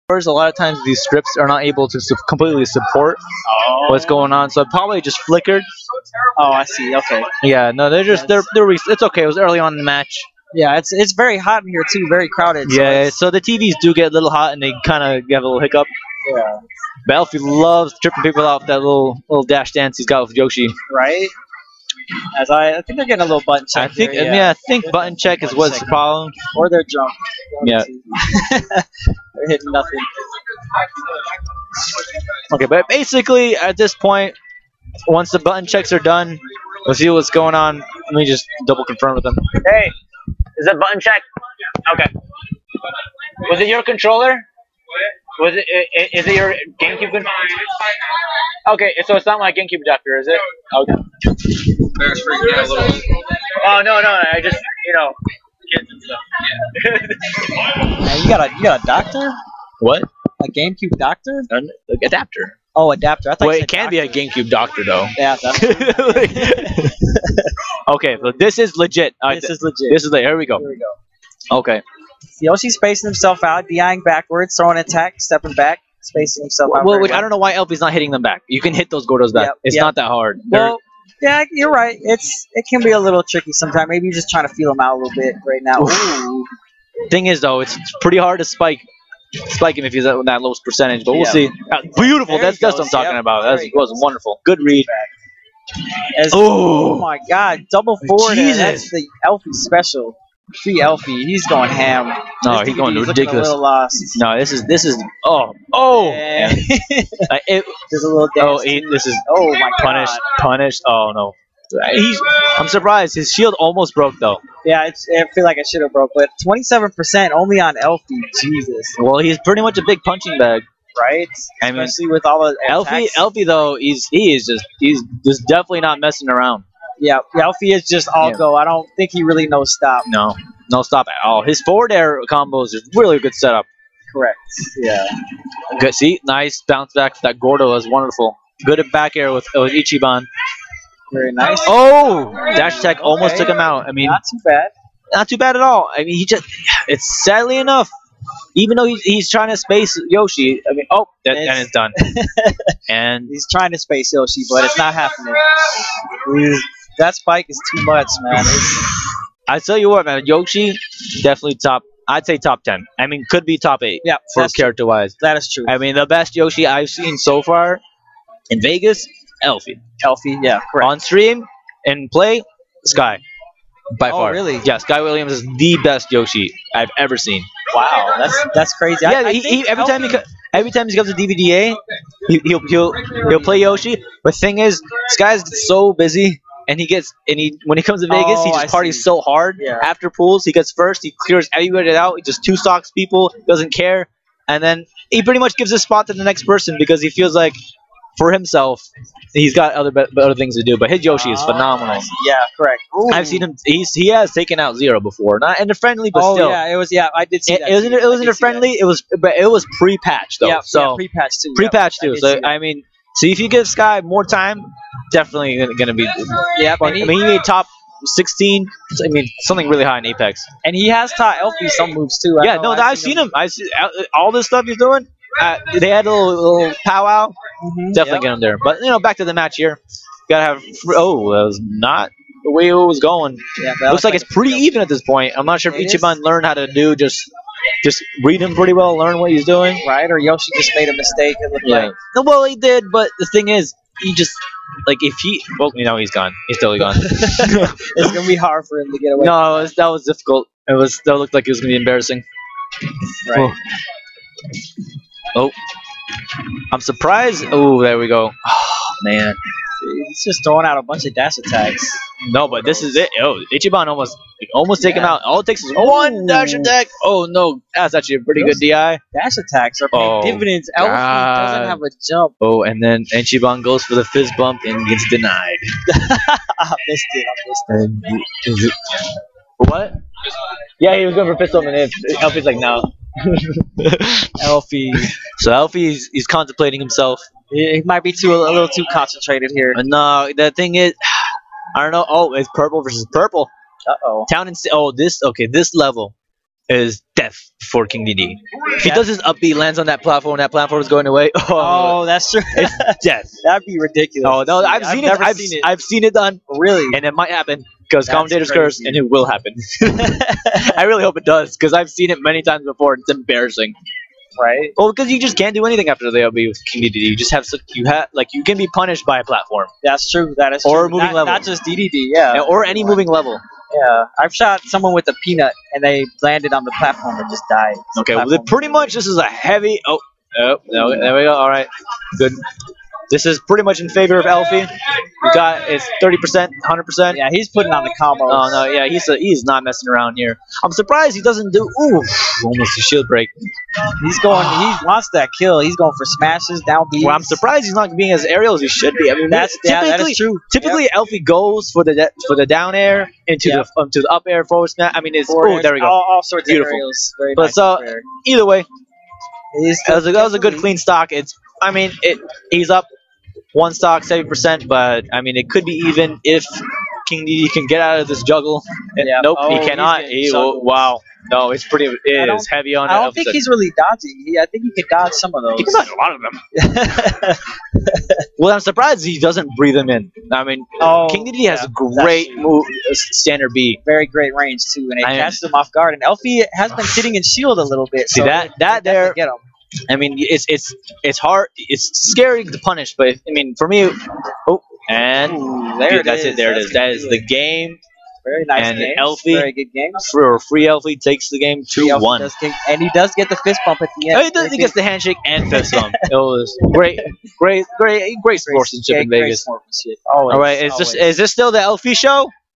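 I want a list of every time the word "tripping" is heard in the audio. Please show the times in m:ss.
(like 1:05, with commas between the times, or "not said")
0:18.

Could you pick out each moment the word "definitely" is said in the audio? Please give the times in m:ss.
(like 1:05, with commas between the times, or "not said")
2:05, 2:41, 3:35, 3:47.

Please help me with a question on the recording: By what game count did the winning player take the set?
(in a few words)
2-1.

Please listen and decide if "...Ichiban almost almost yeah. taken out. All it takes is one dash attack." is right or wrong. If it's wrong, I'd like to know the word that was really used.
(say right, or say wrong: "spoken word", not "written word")
right.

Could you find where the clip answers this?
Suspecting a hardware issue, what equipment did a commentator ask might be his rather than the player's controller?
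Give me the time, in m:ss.
0:49.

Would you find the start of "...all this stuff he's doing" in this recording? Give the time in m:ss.
3:44.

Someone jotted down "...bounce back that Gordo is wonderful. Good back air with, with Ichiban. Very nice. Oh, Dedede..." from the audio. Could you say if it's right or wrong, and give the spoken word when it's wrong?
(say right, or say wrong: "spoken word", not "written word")
wrong: "Dash", not "Dedede".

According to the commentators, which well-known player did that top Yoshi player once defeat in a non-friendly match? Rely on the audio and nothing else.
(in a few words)
Zero.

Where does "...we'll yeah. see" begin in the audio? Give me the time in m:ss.
1:31.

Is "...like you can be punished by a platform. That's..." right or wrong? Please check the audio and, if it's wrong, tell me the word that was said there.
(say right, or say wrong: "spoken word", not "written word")
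right.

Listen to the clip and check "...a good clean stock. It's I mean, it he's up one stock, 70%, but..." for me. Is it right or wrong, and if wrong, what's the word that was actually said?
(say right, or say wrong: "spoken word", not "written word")
right.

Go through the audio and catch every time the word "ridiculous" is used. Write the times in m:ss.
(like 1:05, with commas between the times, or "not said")
1:43, 5:03.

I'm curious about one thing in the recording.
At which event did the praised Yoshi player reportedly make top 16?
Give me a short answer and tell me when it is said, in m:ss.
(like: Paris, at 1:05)
Apex, at 3:40.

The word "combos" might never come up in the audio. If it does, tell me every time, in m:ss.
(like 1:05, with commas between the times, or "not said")
2:12, 5:37.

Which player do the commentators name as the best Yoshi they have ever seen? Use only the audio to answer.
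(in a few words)
Sky Williams.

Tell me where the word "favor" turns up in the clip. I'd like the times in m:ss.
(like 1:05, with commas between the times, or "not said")
5:33.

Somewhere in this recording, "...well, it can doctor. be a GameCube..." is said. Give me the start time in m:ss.
1:03.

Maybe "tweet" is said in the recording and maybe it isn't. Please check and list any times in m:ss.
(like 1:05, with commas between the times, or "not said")
not said.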